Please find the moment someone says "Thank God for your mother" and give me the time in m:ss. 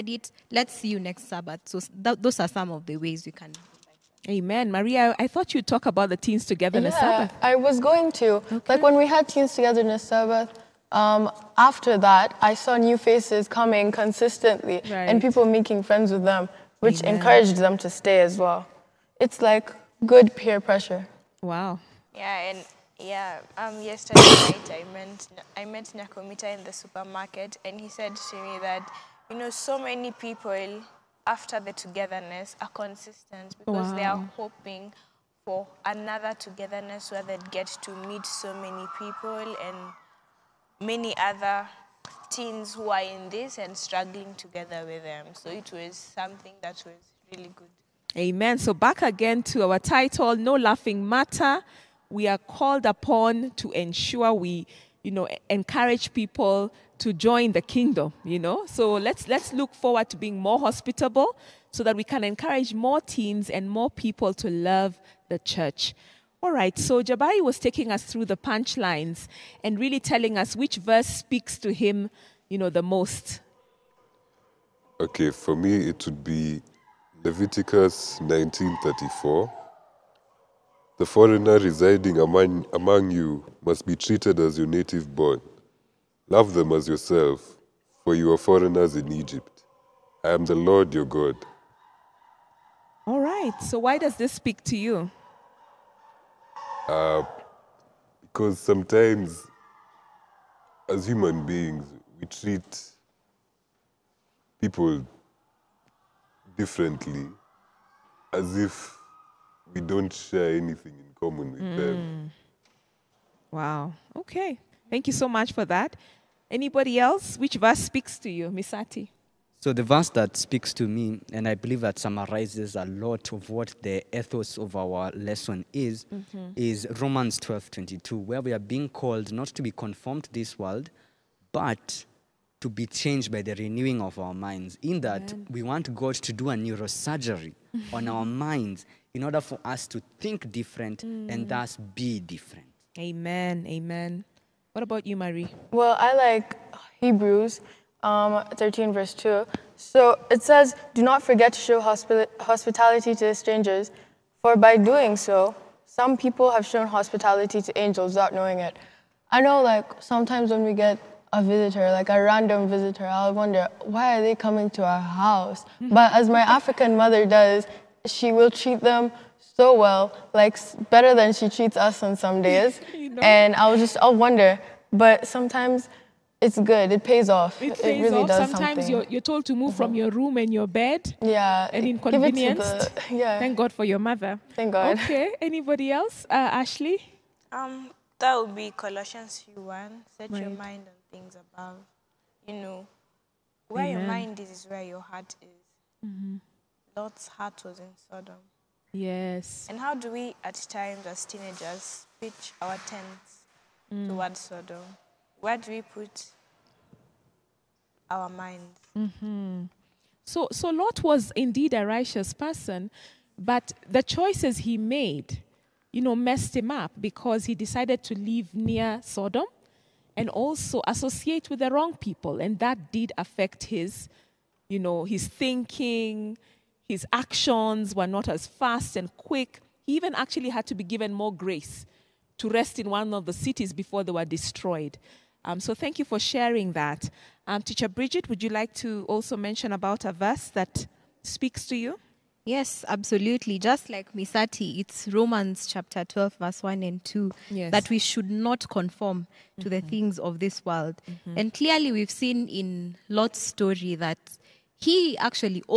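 3:03.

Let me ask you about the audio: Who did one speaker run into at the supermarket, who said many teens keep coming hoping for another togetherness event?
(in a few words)
Nakomita.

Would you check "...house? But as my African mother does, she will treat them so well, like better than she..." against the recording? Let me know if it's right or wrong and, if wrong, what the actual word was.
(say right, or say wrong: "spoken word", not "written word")
right.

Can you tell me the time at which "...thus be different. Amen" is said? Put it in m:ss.
2:21.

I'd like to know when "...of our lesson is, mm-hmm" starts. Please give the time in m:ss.
2:04.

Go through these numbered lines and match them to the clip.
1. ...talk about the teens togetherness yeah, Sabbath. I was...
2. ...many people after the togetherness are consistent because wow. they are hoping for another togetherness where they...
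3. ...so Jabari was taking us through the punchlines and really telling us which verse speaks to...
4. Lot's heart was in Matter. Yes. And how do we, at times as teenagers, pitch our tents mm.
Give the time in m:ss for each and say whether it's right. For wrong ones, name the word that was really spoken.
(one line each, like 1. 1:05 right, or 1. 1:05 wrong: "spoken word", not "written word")
1. 0:05 right
2. 0:29 right
3. 1:06 right
4. 3:16 wrong: "Sodom", not "Matter".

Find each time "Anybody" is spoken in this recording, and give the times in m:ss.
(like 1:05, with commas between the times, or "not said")
1:56, 3:05.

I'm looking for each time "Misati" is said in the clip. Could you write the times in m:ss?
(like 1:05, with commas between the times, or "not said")
1:58, 4:04.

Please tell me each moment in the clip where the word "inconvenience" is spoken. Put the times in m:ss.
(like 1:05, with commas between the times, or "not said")
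3:01.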